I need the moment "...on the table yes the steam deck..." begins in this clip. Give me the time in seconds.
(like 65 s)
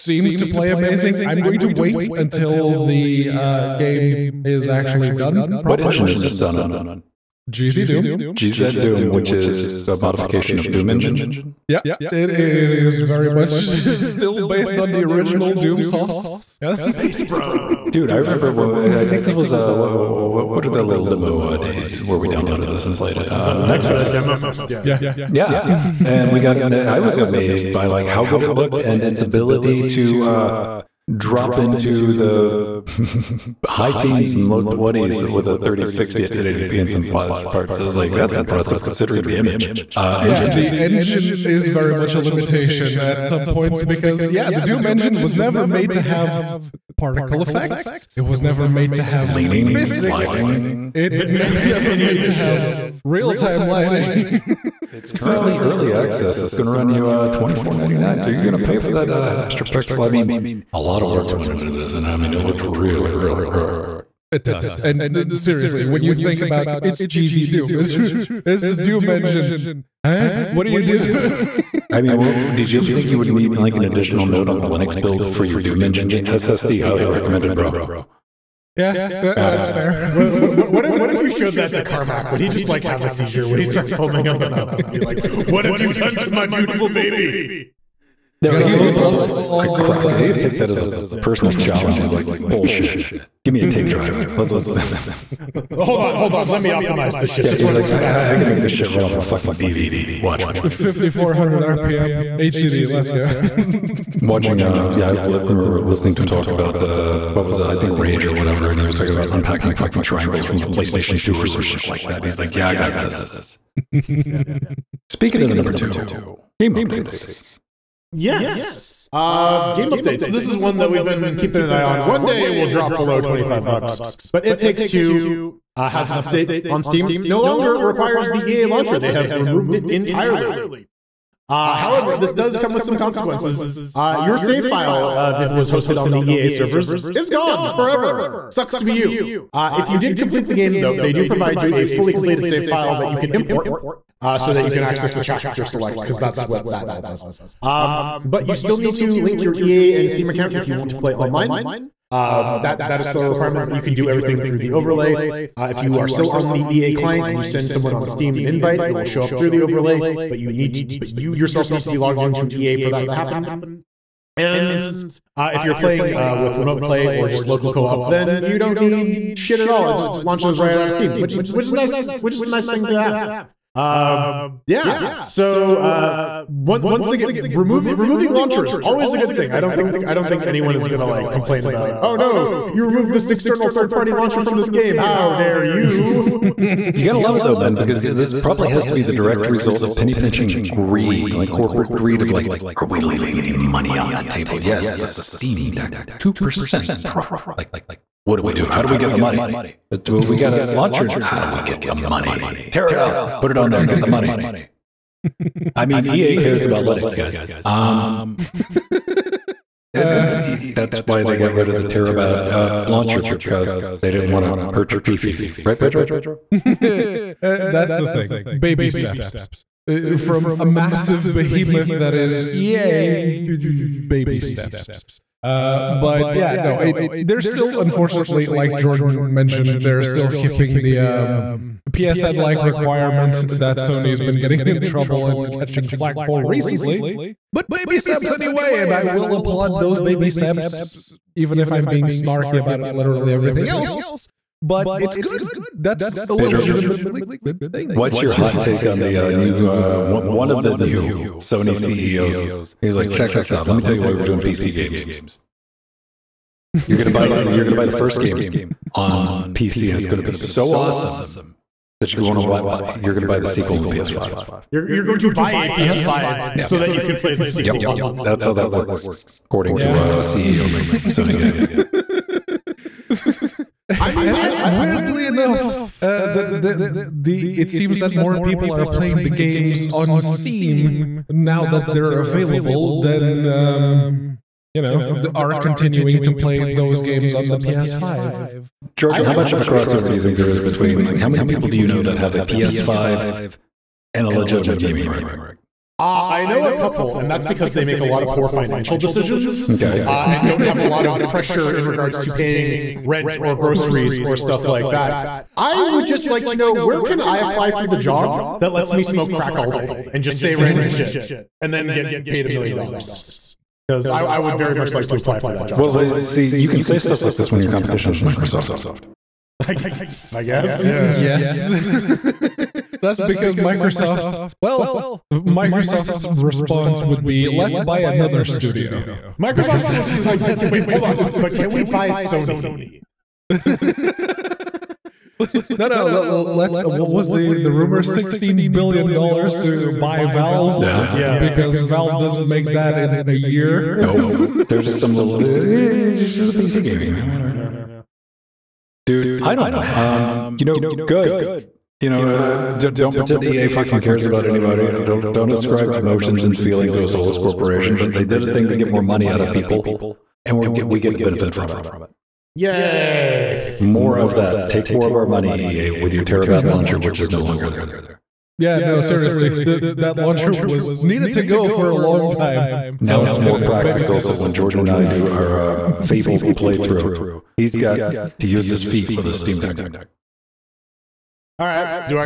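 193 s.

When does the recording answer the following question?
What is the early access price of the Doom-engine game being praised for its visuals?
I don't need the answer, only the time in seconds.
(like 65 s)
57 s.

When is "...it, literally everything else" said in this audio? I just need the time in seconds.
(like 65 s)
242 s.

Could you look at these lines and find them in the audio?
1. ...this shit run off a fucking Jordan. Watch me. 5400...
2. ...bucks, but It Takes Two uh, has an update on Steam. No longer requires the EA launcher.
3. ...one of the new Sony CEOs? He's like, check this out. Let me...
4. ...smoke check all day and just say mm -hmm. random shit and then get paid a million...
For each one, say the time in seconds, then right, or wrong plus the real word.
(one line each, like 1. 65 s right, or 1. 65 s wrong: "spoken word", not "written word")
1. 98 s wrong: "DVD", not "Jordan"
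2. 123 s right
3. 250 s right
4. 309 s wrong: "crack", not "check".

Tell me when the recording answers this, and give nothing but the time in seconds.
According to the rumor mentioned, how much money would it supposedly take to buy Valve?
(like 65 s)
338 s.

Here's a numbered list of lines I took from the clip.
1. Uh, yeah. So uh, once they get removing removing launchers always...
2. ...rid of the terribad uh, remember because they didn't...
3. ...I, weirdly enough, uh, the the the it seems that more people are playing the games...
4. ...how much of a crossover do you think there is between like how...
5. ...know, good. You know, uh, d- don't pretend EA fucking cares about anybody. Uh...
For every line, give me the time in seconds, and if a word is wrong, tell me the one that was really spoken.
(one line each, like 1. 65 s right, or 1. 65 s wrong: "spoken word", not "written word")
1. 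173 s right
2. 211 s wrong: "launcher", not "remember"
3. 274 s right
4. 289 s right
5. 350 s right.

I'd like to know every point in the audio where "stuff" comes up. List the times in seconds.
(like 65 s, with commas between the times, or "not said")
304 s, 316 s.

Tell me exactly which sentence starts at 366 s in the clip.
launcher, which is no longer there.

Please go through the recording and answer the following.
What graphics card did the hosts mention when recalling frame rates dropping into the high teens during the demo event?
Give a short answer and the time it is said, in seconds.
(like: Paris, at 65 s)
3060, at 35 s.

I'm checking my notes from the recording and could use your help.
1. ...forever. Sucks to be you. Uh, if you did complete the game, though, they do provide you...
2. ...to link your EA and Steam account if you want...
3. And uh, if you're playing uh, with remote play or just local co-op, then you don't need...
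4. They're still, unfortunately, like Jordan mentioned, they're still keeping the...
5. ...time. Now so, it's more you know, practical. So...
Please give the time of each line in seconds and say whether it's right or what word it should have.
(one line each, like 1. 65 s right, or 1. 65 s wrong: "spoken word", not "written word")
1. 137 s right
2. 148 s right
3. 164 s right
4. 227 s right
5. 372 s right.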